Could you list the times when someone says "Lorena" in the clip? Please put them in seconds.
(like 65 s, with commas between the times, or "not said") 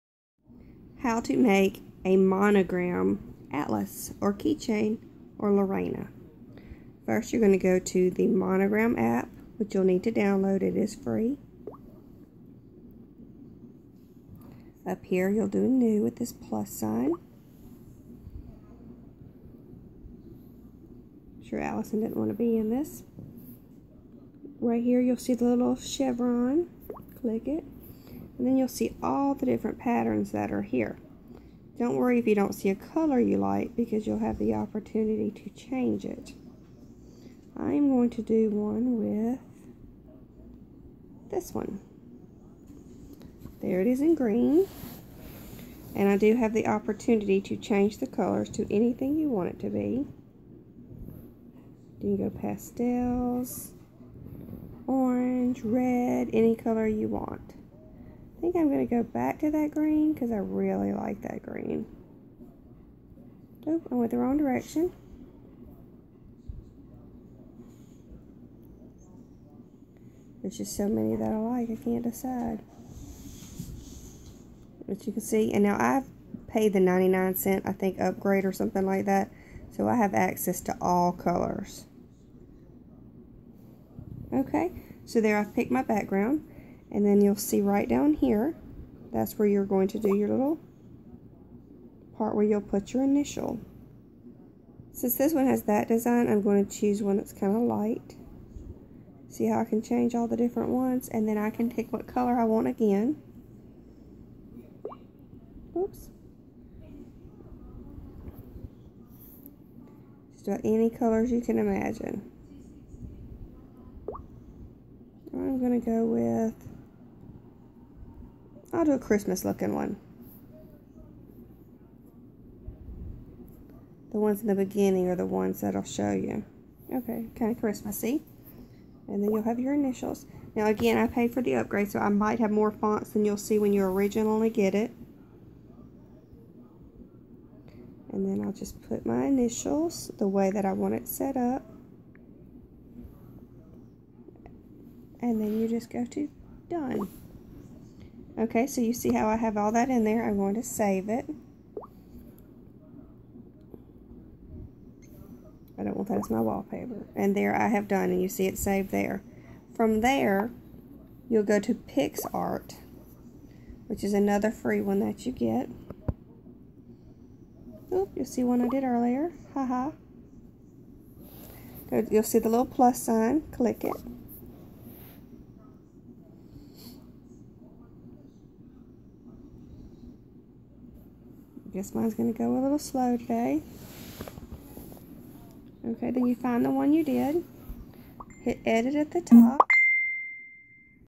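5 s.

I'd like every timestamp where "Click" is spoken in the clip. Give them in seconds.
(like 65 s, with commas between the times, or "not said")
27 s, 173 s.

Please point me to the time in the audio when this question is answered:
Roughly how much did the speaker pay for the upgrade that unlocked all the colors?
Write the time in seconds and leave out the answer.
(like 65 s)
76 s.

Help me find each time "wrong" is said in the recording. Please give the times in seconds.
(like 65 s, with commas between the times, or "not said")
64 s.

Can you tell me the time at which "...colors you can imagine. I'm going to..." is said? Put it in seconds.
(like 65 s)
110 s.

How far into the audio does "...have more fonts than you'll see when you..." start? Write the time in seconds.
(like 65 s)
132 s.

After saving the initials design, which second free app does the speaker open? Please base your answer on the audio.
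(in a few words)
PicsArt.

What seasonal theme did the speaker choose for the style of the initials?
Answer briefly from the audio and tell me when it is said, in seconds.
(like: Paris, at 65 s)
Christmas, at 118 s.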